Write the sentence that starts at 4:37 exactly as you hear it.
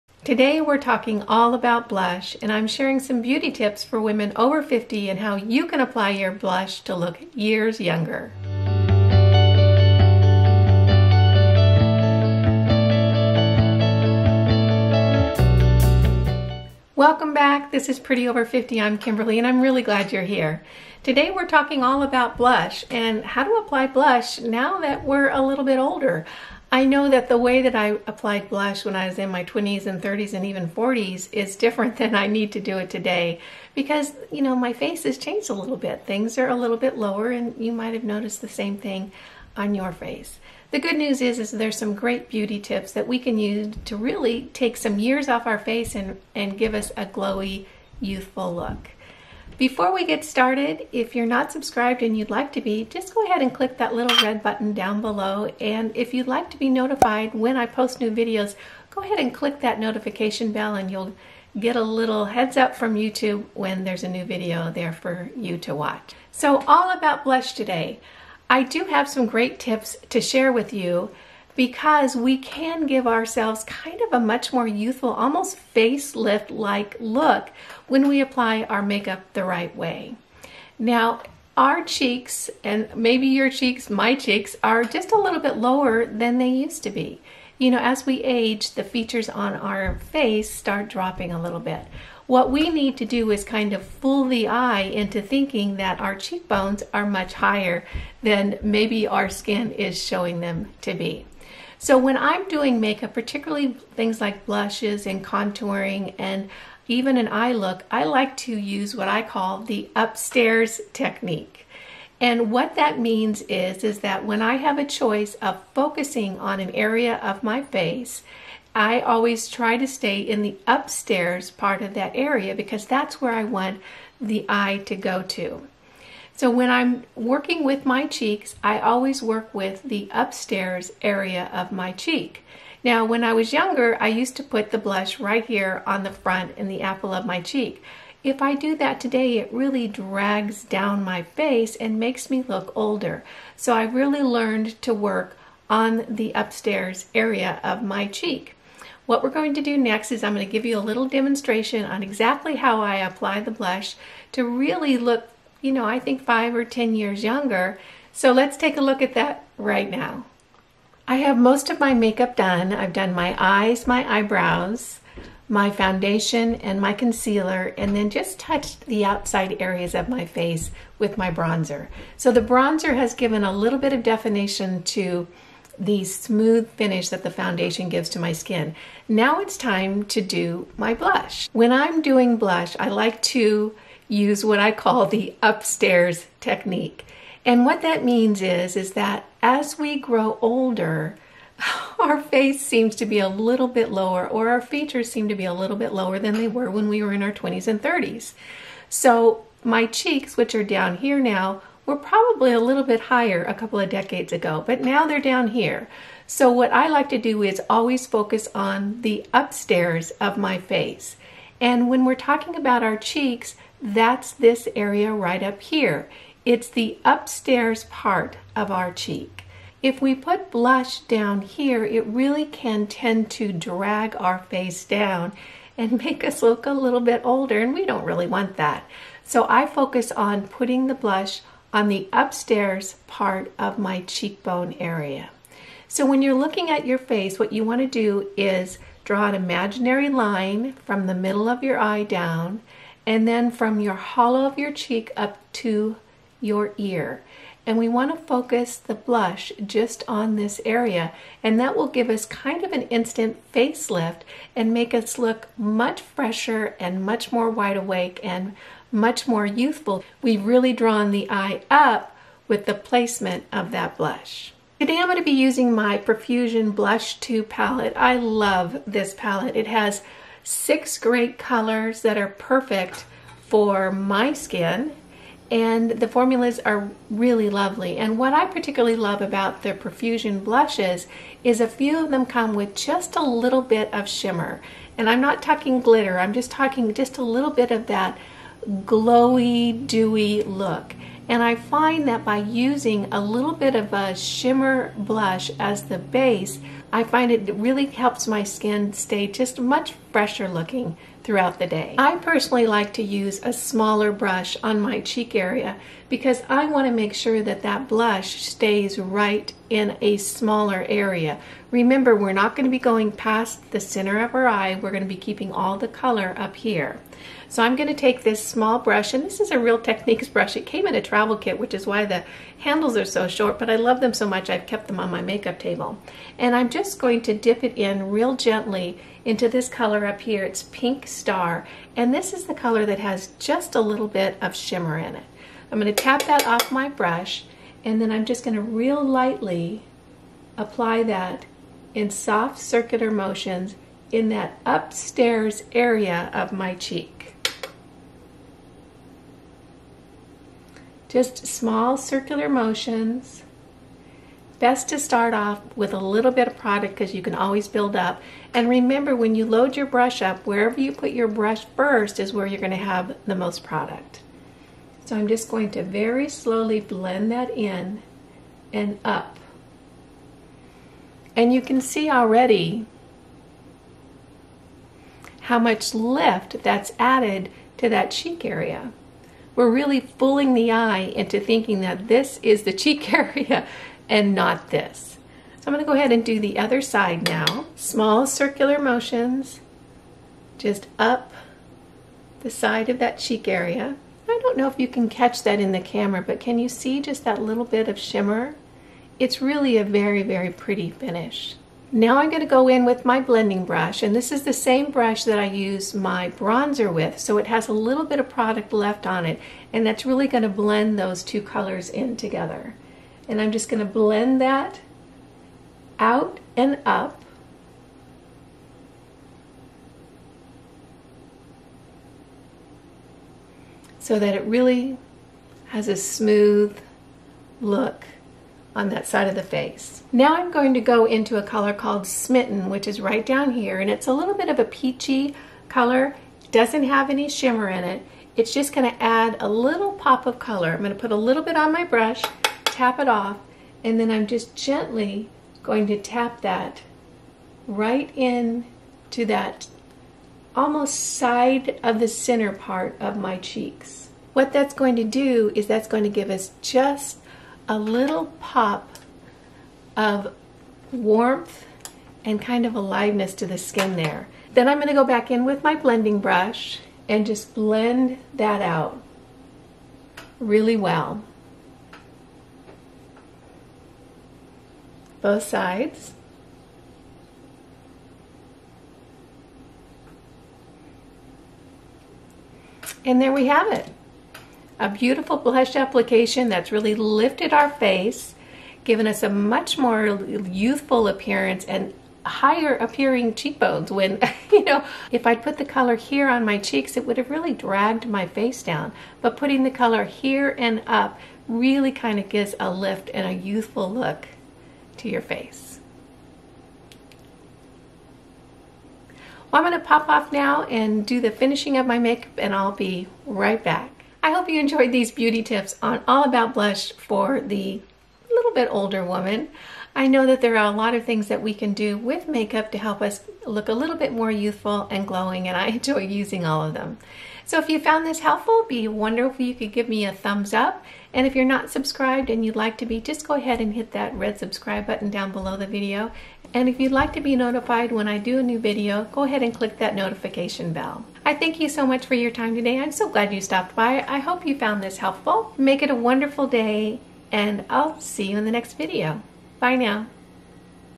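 And what I particularly love about the Profusion blushes is a few of them come with just a little bit of shimmer.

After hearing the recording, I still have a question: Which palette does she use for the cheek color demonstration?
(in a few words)
Profusion Blush 2.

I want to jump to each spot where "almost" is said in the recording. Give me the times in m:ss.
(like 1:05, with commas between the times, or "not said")
1:15, 7:30.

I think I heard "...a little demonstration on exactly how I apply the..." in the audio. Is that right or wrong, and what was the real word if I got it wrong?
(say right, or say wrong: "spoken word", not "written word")
right.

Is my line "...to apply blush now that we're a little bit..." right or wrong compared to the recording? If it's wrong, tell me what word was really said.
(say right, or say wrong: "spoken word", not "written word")
right.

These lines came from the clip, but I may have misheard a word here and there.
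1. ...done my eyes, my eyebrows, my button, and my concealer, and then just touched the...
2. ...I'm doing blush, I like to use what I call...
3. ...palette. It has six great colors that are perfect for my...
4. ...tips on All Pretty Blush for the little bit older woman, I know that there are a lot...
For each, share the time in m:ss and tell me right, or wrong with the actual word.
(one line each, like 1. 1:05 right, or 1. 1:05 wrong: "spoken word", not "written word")
1. 2:42 wrong: "foundation", not "button"
2. 3:01 right
3. 4:29 right
4. 8:35 wrong: "About", not "Pretty".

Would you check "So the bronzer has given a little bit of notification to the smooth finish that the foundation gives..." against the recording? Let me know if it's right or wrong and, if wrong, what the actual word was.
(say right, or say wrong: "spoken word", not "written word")
wrong: "definition", not "notification".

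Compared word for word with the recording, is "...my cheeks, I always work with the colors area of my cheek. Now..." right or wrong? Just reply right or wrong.
wrong.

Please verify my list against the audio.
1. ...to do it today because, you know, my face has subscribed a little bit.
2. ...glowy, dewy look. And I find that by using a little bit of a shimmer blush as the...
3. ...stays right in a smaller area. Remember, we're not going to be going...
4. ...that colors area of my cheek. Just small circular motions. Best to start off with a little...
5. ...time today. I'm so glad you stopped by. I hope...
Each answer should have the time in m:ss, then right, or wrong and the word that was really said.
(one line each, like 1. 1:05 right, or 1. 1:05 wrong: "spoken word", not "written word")
1. 0:32 wrong: "changed", not "subscribed"
2. 4:48 right
3. 5:08 right
4. 5:44 wrong: "upstairs", not "colors"
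5. 9:02 right.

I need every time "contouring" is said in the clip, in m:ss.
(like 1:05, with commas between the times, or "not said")
1:45.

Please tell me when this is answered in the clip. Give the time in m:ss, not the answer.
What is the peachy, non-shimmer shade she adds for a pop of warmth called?
7:12.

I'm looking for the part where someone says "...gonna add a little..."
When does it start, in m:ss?
7:18.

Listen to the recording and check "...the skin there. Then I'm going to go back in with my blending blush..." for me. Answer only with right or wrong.
wrong.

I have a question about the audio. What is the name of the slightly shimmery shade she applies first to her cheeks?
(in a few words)
Pink Star.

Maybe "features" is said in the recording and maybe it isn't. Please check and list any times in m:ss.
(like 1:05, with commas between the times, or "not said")
1:28, 3:14.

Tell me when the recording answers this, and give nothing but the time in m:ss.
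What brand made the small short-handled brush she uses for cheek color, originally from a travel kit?
5:19.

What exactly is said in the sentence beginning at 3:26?
So what I like to do is always focus on the upstairs of my face.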